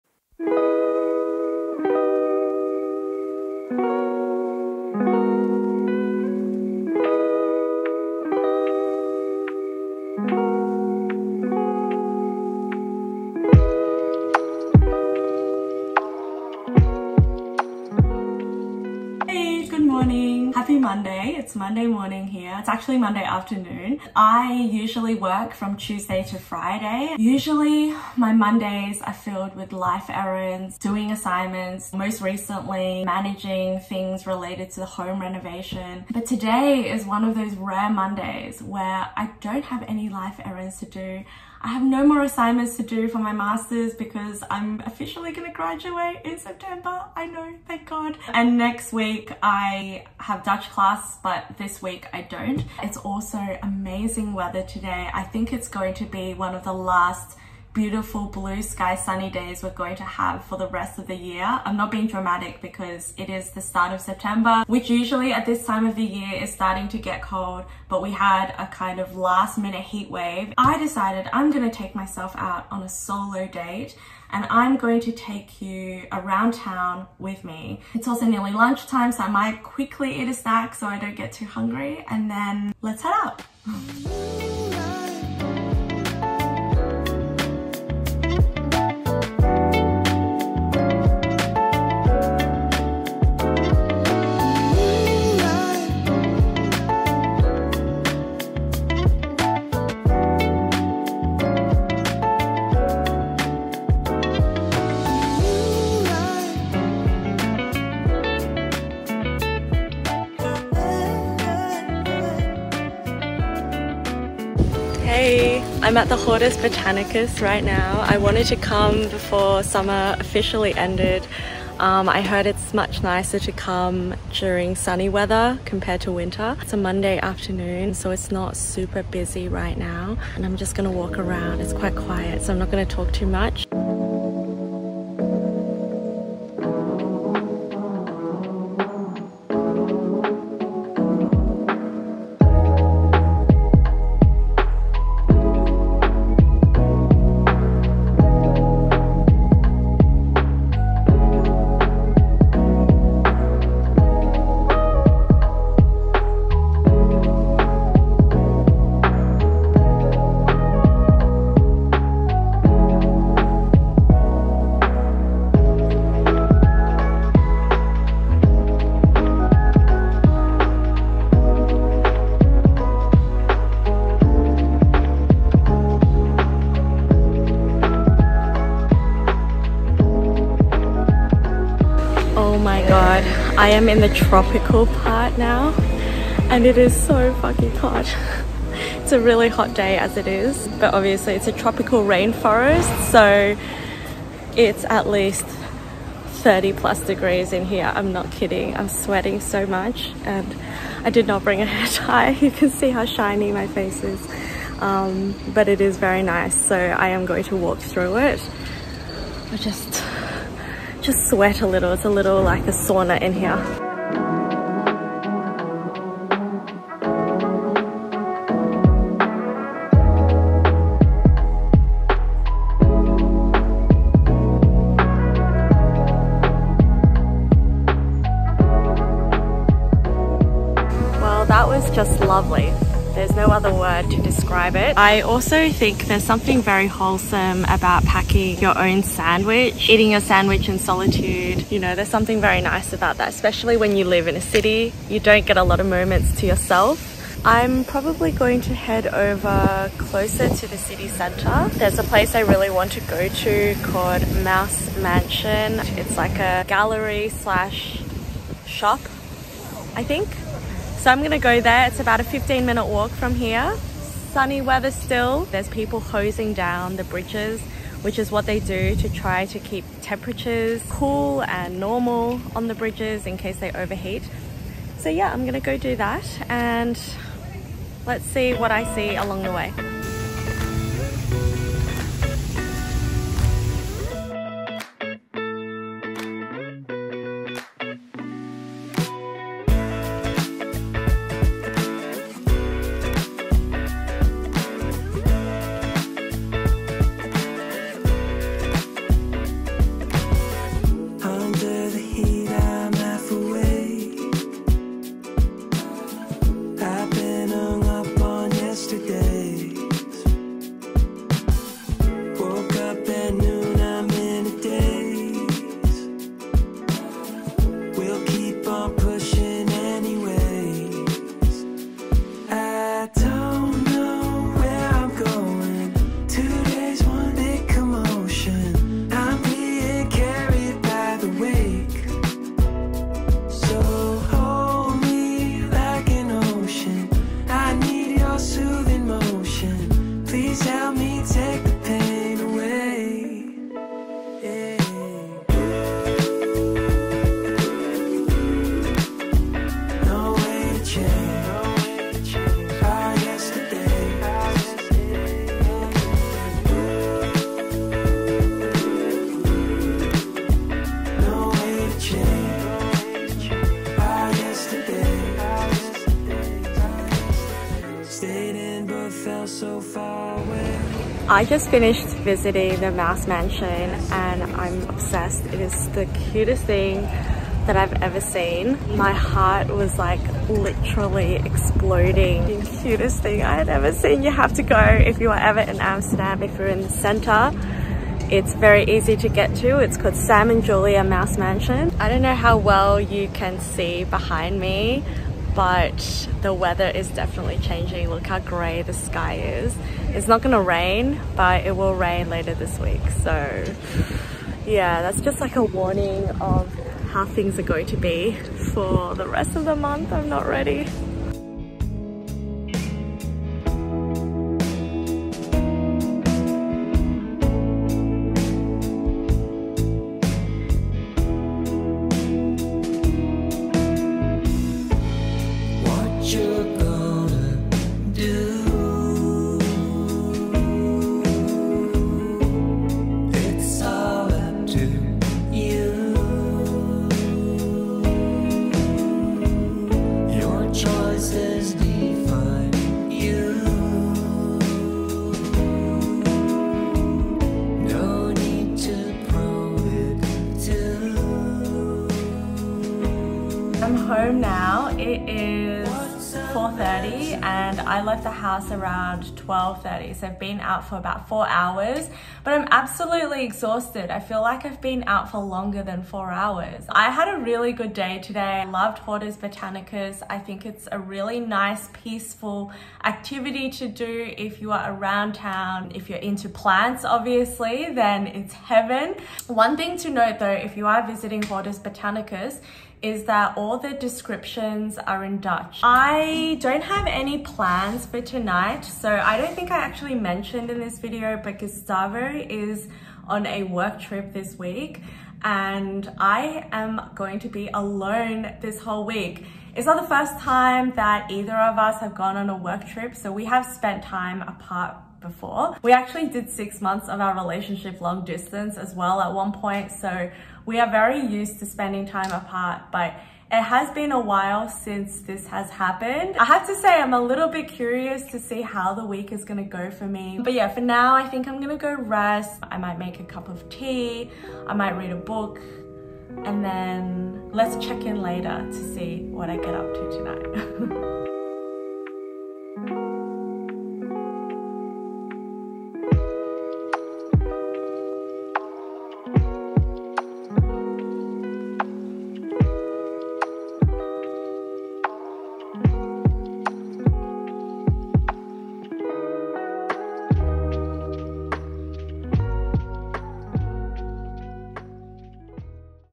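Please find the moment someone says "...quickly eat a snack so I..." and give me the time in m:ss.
1:19.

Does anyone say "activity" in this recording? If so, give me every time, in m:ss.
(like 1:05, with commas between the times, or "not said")
7:53.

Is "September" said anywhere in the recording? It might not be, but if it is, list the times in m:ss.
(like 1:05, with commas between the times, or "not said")
0:46, 1:04.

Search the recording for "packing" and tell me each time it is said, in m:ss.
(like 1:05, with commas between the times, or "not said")
3:58.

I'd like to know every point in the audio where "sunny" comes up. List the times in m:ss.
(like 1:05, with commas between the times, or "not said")
0:58, 2:04, 4:24.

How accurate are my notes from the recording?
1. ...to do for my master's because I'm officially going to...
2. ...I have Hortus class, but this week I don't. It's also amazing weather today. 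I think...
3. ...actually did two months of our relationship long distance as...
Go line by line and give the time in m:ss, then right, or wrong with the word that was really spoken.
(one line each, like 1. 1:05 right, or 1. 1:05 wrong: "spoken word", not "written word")
1. 0:42 right
2. 0:49 wrong: "Dutch", not "Hortus"
3. 8:25 wrong: "six", not "two".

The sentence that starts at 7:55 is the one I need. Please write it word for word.
If you're into plants, obviously, then it's heaven.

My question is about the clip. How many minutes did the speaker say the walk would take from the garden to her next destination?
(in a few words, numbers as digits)
15.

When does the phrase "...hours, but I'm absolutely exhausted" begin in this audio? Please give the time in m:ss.
7:41.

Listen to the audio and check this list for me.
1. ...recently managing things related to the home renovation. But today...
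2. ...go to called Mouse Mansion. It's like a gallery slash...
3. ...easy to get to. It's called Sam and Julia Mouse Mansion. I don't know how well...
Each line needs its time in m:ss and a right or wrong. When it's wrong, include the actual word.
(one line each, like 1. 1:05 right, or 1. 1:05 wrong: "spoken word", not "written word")
1. 0:32 right
2. 4:13 right
3. 6:28 right.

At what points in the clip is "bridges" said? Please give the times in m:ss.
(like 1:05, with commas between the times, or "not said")
4:27, 4:32.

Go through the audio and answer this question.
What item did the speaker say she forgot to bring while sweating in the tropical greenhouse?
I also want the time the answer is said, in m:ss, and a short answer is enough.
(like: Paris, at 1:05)
hair tie, at 3:21.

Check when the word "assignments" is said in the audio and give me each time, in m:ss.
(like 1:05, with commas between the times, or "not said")
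0:31, 0:42.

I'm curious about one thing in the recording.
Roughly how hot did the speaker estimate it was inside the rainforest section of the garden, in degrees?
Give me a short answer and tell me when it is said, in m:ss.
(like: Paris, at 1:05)
30 plus, at 3:16.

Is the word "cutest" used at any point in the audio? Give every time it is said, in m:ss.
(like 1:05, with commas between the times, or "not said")
6:16, 6:22.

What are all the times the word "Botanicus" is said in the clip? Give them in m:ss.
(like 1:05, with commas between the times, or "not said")
1:56, 7:49, 8:01.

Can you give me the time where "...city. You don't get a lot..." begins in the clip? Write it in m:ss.
4:04.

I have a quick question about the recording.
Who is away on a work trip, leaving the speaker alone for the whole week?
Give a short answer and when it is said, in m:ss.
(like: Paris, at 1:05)
Gustavo, at 8:11.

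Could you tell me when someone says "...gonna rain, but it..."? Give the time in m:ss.
6:40.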